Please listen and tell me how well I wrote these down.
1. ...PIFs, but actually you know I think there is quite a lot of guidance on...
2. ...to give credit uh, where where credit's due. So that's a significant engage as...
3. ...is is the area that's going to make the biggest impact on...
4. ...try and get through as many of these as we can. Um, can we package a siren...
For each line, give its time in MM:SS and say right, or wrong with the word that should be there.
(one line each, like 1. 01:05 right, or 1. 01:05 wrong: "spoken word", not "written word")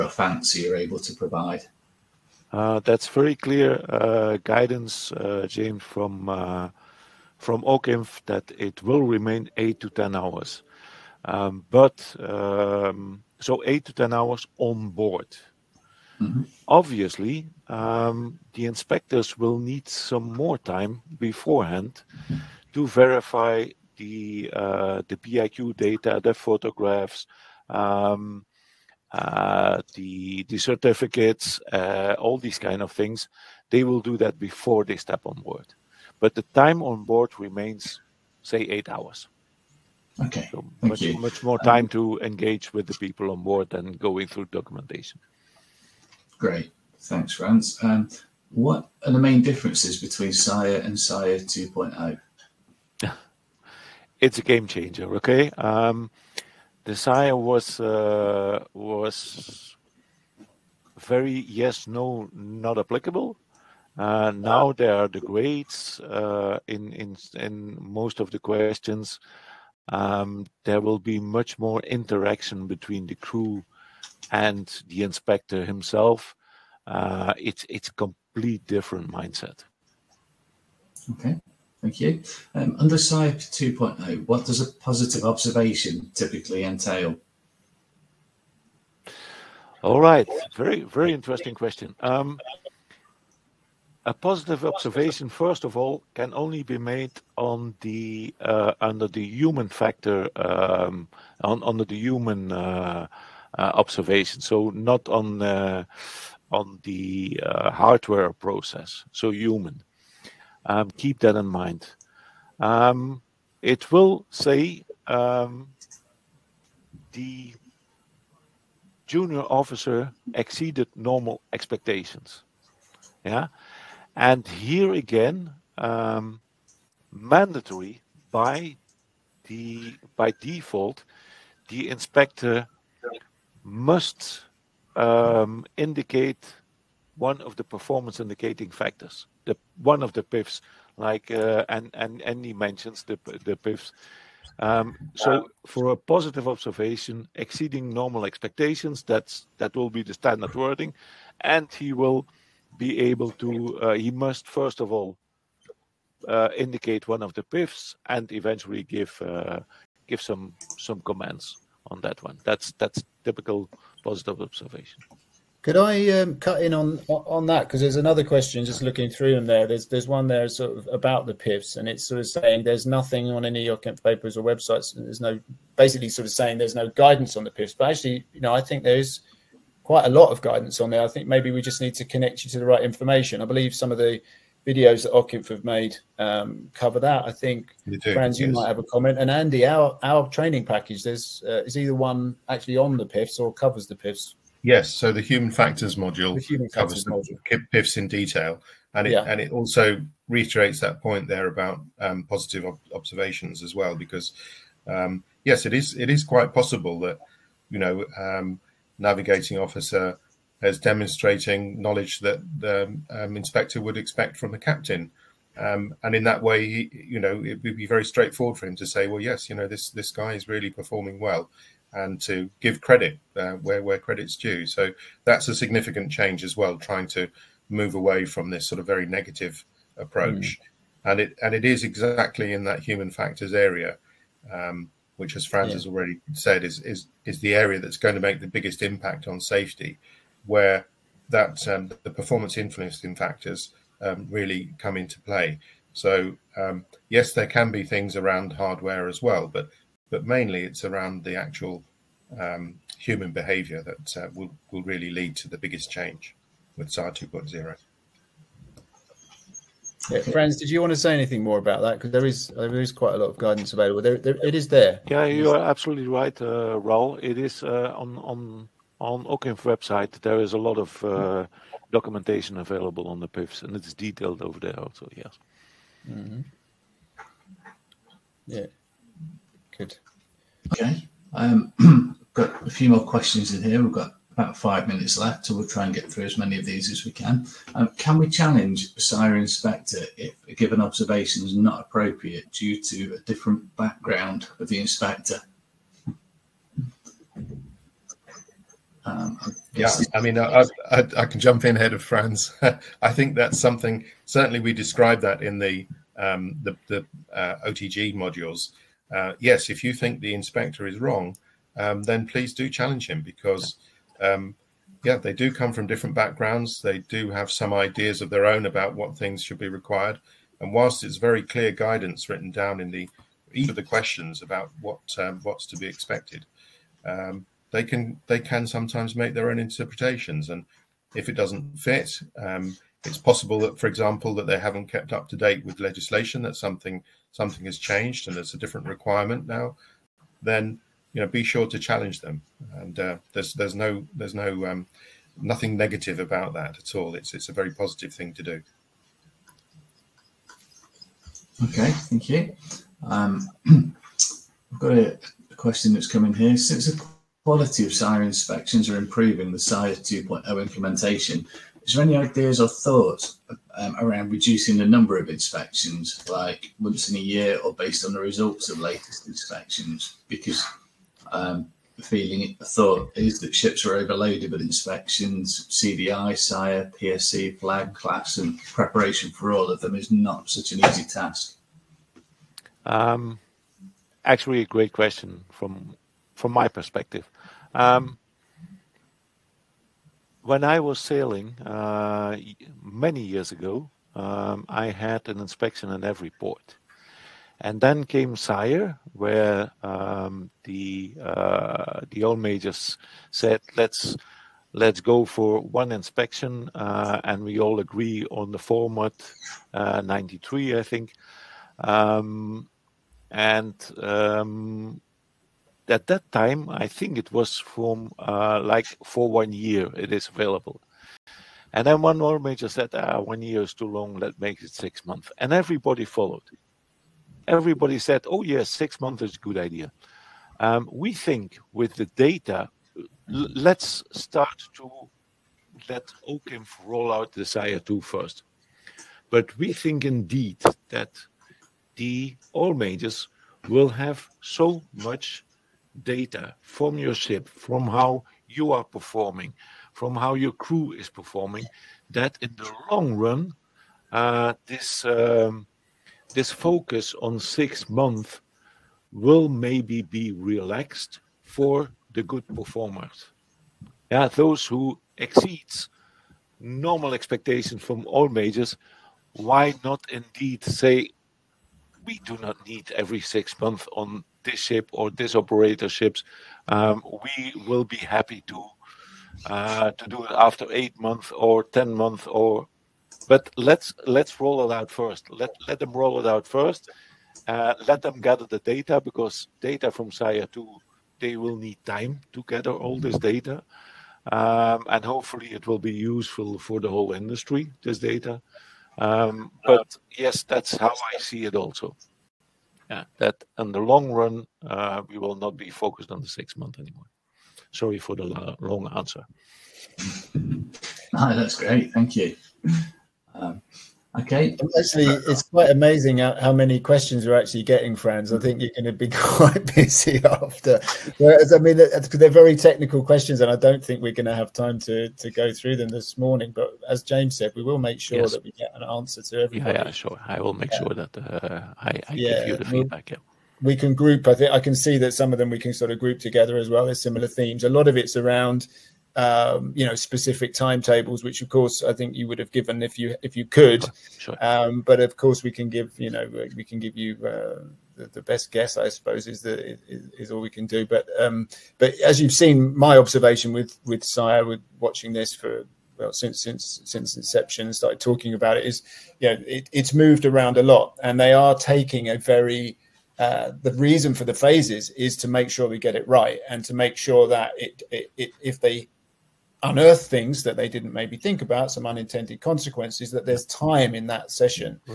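1. 02:57 right
2. 03:42 wrong: "change", not "engage"
3. 03:56 right
4. 04:45 wrong: "challenge", not "package".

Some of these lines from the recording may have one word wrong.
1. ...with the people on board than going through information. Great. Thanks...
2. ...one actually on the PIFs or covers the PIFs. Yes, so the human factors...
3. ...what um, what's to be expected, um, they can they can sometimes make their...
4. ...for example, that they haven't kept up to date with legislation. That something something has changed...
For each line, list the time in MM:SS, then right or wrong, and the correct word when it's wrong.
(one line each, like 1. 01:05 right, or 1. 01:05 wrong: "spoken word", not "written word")
1. 00:42 wrong: "documentation", not "information"
2. 03:11 right
3. 05:24 right
4. 05:33 right.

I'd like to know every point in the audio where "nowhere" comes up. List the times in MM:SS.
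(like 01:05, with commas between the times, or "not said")
not said.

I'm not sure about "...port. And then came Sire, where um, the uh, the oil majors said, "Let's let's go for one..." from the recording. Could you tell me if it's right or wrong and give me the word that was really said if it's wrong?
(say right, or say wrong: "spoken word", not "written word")
right.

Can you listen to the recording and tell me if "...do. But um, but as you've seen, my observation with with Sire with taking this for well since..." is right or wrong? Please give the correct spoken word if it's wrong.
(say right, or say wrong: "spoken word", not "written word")
wrong: "watching", not "taking".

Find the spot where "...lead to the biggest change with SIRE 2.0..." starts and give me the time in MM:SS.
04:15.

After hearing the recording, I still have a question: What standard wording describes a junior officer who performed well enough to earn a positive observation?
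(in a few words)
Exceeded normal expectations.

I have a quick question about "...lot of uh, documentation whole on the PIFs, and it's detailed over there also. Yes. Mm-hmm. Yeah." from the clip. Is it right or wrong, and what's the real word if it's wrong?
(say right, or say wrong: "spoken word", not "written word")
wrong: "available", not "whole".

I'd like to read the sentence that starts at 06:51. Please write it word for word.
Um, and um, at that time, I think it was from uh, like for one year it is available.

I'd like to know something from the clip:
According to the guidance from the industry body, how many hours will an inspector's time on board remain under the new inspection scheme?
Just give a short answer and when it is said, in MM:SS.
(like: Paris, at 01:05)
8 to 10 hours, at 00:09.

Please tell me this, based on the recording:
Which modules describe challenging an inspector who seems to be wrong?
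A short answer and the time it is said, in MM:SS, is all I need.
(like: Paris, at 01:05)
OTG modules, at 05:07.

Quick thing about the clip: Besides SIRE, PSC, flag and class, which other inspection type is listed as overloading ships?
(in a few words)
CDI.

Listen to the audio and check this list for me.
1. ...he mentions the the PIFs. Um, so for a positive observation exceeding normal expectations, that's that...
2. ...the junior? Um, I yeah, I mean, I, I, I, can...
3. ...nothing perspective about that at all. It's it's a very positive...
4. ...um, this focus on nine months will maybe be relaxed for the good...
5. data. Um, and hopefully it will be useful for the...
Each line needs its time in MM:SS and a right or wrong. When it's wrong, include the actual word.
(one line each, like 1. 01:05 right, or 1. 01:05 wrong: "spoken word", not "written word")
1. 02:22 right
2. 04:54 wrong: "inspector", not "junior"
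3. 05:45 wrong: "negative", not "perspective"
4. 07:35 wrong: "six", not "nine"
5. 08:13 right.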